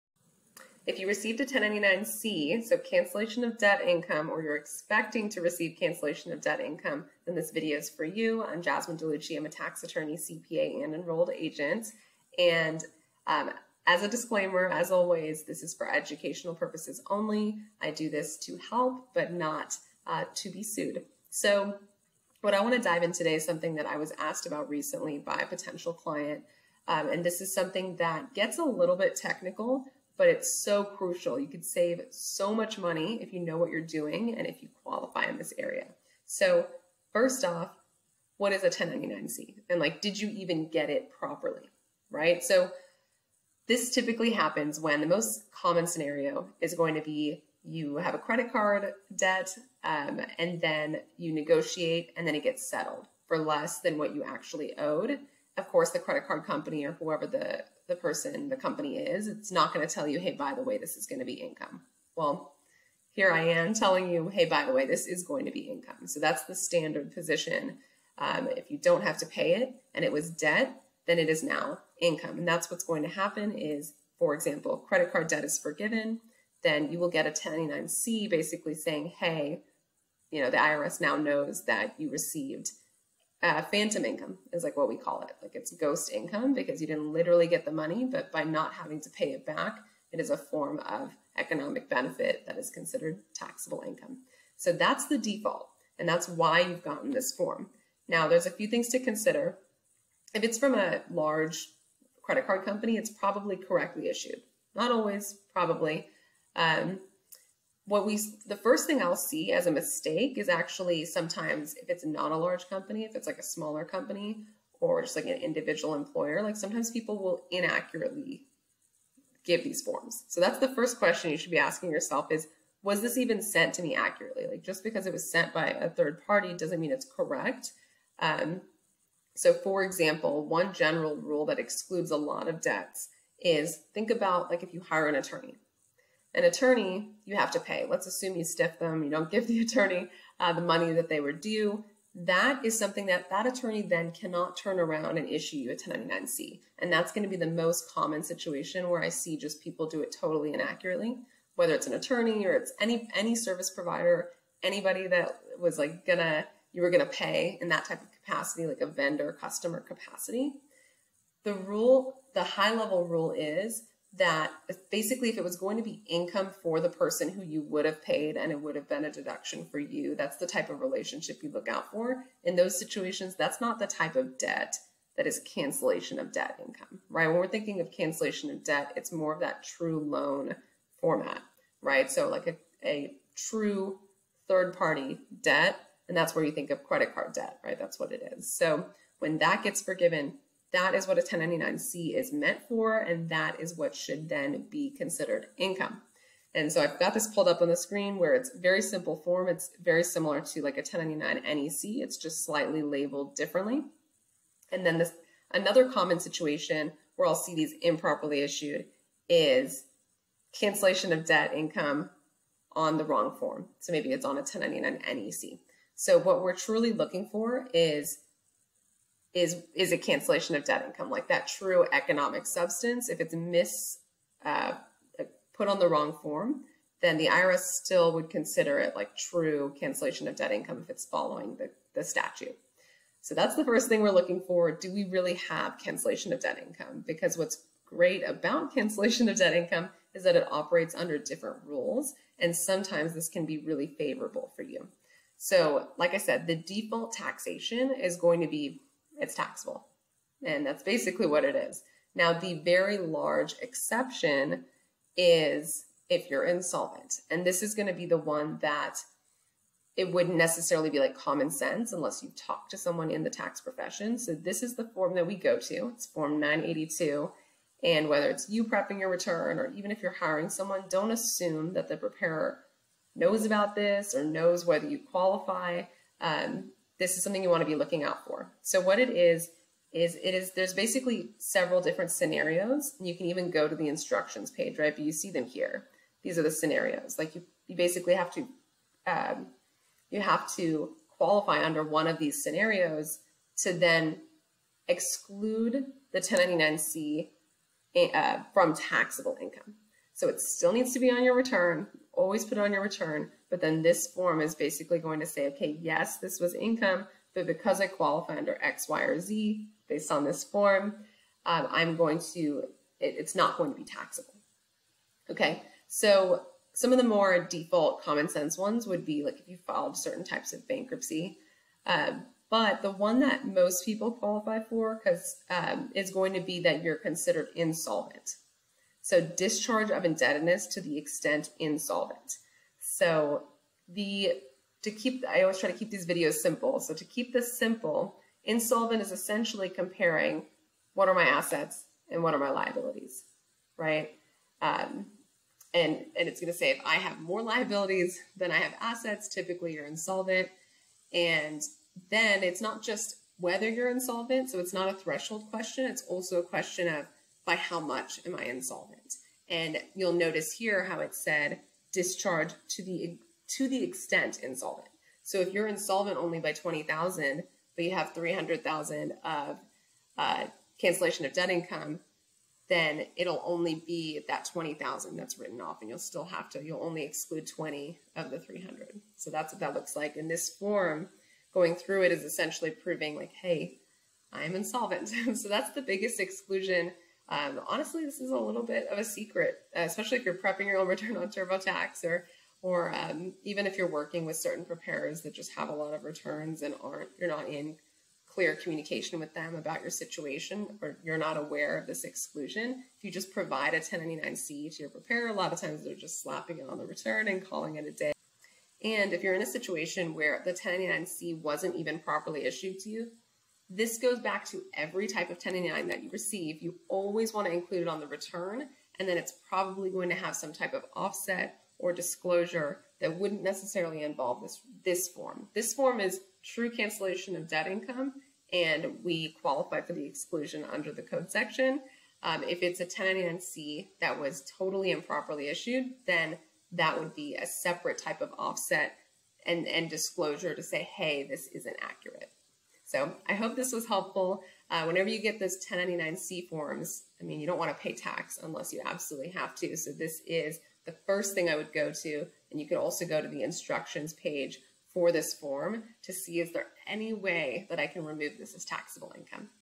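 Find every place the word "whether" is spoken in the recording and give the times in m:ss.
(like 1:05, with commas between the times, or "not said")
2:31, 4:28, 4:34, 5:53.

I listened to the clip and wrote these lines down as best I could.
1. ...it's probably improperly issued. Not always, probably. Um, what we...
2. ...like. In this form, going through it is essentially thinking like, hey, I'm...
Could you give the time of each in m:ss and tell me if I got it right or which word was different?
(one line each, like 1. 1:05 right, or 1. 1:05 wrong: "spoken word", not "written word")
1. 1:42 wrong: "correctly", not "improperly"
2. 6:19 wrong: "proving", not "thinking".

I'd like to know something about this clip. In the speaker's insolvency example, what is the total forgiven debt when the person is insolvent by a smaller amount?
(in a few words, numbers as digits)
300,000.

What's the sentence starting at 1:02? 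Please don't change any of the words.
Well, here I am telling you, hey, by the way, this is going to be income.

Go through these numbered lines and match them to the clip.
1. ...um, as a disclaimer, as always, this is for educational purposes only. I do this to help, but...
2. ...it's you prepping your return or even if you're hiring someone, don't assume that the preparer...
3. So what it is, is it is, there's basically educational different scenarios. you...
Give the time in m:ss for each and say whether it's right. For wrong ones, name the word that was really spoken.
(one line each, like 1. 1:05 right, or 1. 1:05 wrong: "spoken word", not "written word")
1. 0:13 right
2. 4:28 right
3. 4:38 wrong: "several", not "educational".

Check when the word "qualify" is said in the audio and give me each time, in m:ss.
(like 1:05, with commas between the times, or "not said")
0:34, 4:34, 4:51, 5:07, 5:24, 7:09.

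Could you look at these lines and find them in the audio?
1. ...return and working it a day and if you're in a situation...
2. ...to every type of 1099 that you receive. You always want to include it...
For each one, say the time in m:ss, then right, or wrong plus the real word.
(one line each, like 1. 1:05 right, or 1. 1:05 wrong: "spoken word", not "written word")
1. 6:46 wrong: "calling", not "working"
2. 6:54 right.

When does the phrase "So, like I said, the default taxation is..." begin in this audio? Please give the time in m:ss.
4:05.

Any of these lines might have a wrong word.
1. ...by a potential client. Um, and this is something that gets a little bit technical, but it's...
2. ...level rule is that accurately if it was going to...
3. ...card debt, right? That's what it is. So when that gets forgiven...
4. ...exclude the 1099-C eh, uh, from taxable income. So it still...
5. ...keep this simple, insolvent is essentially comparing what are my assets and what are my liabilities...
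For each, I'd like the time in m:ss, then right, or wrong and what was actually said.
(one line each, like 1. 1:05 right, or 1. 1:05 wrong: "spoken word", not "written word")
1. 0:25 right
2. 2:42 wrong: "basically", not "accurately"
3. 3:07 right
4. 4:54 right
5. 5:37 right.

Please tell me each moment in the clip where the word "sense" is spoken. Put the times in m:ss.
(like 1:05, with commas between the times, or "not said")
4:21, 5:18.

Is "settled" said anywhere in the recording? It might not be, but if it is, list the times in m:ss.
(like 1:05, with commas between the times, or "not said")
0:52.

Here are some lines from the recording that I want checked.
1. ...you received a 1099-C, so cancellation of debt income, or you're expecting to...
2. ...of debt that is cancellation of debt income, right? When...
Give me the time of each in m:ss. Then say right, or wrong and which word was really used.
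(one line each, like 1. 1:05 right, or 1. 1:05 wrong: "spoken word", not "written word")
1. 0:00 right
2. 2:54 right.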